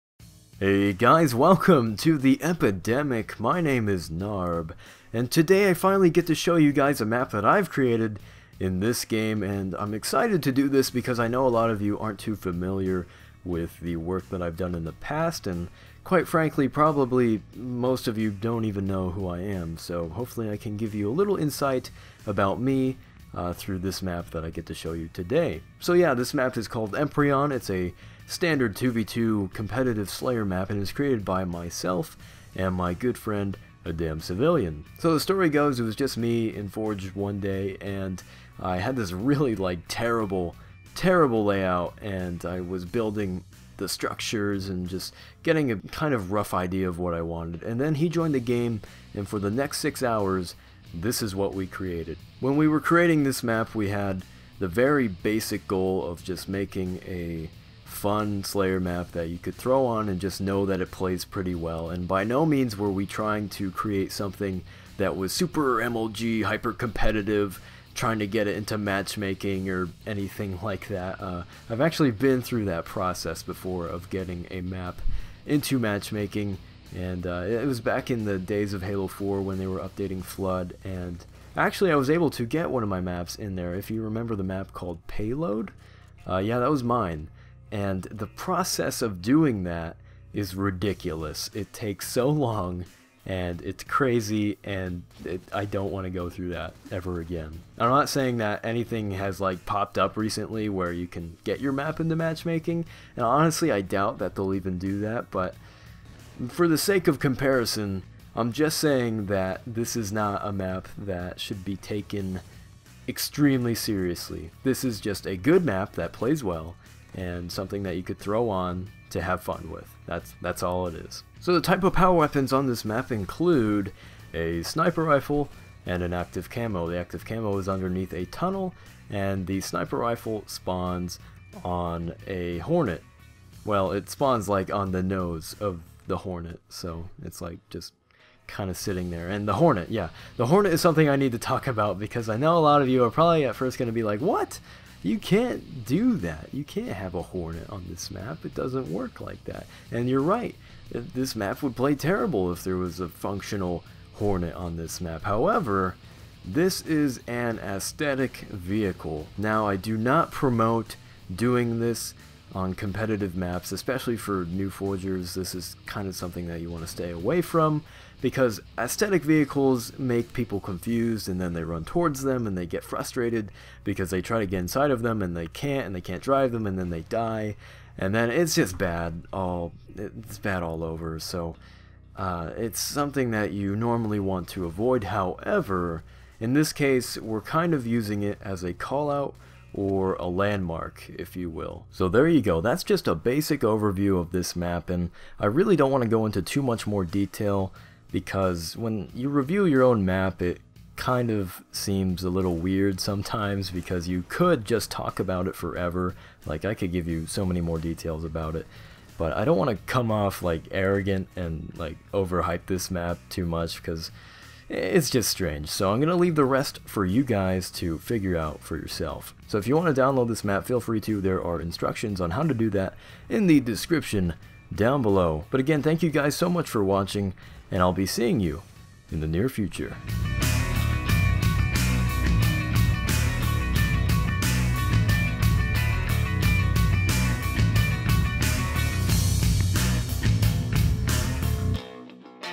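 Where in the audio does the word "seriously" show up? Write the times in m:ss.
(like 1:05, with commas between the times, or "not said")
1:53.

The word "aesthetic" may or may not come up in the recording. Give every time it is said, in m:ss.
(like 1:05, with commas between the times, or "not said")
2:37, 2:48.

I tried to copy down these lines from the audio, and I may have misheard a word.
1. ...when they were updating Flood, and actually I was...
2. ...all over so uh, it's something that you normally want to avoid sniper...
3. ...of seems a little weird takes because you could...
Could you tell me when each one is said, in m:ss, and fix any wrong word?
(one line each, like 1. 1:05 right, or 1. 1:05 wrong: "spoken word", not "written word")
1. 1:19 right
2. 3:00 wrong: "however", not "sniper"
3. 3:21 wrong: "sometimes", not "takes".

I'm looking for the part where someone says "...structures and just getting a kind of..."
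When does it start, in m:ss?
0:43.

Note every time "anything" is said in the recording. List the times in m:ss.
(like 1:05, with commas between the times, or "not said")
1:10, 1:38.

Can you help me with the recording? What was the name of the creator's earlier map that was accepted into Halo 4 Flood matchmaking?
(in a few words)
Payload.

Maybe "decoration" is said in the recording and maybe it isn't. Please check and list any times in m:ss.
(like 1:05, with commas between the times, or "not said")
not said.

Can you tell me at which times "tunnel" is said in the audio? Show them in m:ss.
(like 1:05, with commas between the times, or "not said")
2:08.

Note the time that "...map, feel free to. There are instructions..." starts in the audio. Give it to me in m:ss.
3:40.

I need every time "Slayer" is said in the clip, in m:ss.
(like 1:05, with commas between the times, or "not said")
0:30, 0:58.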